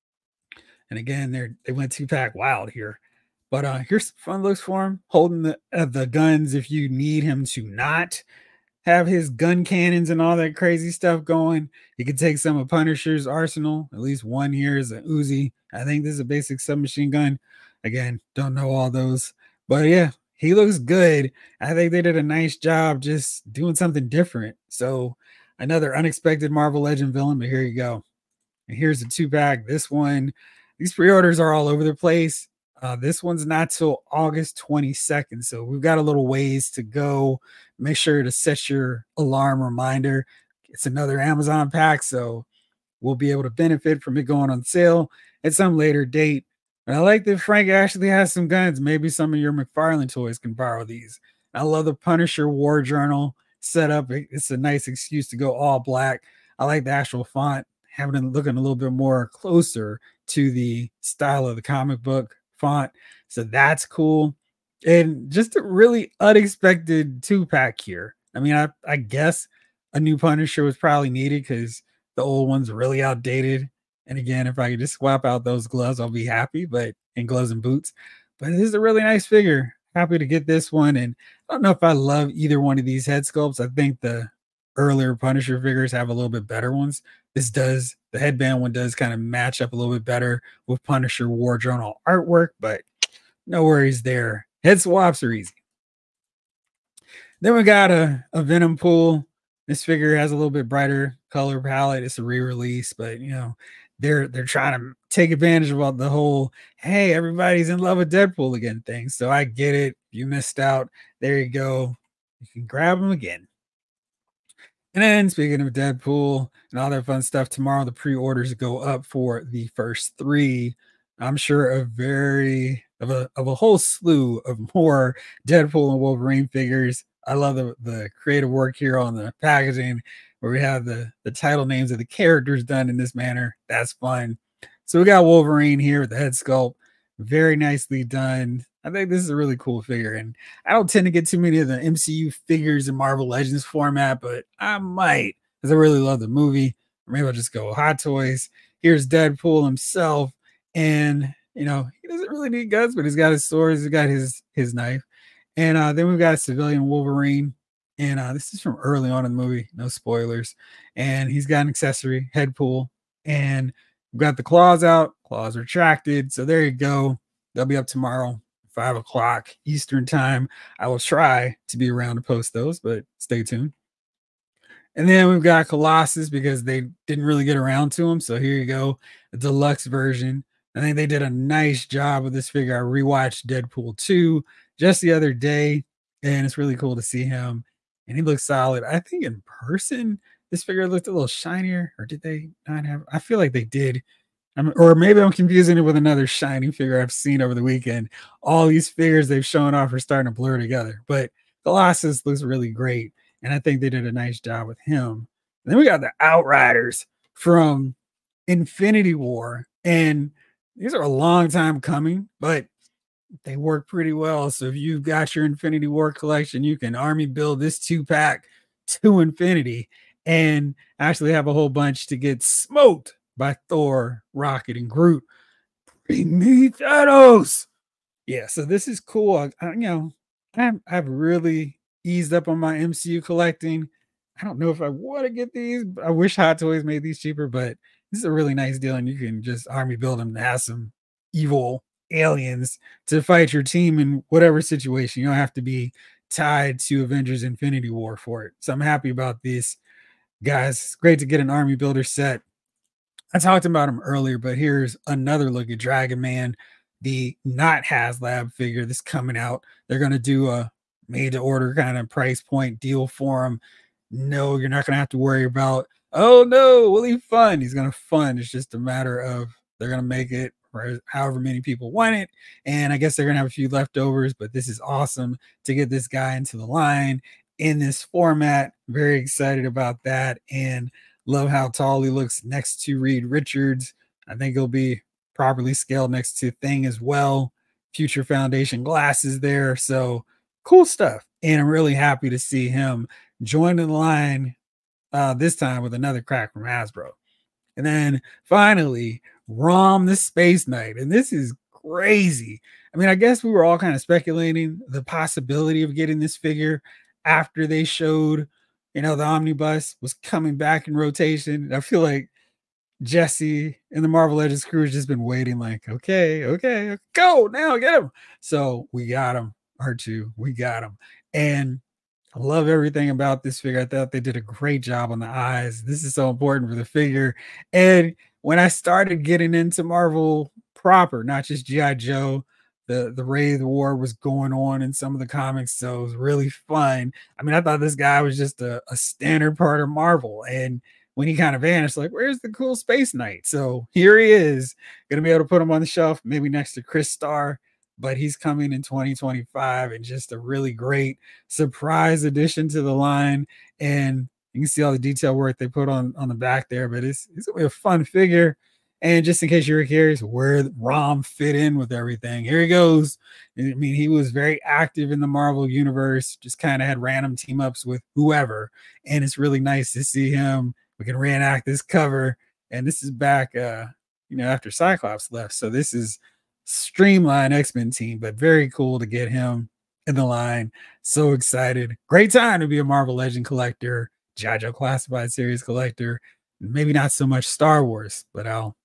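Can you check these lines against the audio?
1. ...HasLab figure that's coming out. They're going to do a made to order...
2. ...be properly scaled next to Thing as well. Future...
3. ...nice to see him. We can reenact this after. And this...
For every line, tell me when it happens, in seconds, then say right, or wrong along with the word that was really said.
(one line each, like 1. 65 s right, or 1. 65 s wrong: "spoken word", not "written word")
1. 257 s right
2. 284 s right
3. 369 s wrong: "cover", not "after".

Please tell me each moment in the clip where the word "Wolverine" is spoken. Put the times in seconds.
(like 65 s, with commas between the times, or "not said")
126 s, 135 s, 156 s.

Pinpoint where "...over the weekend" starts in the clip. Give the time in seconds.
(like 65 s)
197 s.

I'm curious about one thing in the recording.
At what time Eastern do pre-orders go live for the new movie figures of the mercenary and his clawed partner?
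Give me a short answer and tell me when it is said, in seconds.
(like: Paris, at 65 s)
5 o'clock, at 168 s.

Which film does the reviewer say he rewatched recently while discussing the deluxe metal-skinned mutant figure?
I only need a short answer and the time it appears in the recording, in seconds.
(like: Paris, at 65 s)
Deadpool 2, at 183 s.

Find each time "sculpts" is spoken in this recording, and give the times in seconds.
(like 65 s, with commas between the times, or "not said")
83 s, 136 s.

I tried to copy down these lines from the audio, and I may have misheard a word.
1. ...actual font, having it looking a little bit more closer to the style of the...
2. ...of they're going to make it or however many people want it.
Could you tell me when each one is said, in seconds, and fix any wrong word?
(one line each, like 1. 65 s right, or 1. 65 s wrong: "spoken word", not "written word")
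1. 56 s right
2. 269 s right.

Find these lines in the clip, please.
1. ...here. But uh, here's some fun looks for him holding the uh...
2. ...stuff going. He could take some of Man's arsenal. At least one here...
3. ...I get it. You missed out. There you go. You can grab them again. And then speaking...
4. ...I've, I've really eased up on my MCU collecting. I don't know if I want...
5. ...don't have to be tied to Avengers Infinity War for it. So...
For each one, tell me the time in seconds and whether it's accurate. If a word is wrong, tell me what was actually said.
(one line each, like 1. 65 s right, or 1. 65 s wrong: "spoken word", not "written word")
1. 2 s right
2. 10 s wrong: "Punisher", not "Man"
3. 109 s right
4. 230 s right
5. 245 s right.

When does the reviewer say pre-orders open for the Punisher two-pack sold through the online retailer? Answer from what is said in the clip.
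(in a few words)
August 22nd.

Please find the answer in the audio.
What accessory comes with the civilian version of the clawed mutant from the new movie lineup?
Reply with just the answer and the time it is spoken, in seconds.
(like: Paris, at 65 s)
Headpool, at 162 s.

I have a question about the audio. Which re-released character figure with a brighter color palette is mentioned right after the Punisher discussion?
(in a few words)
Venompool.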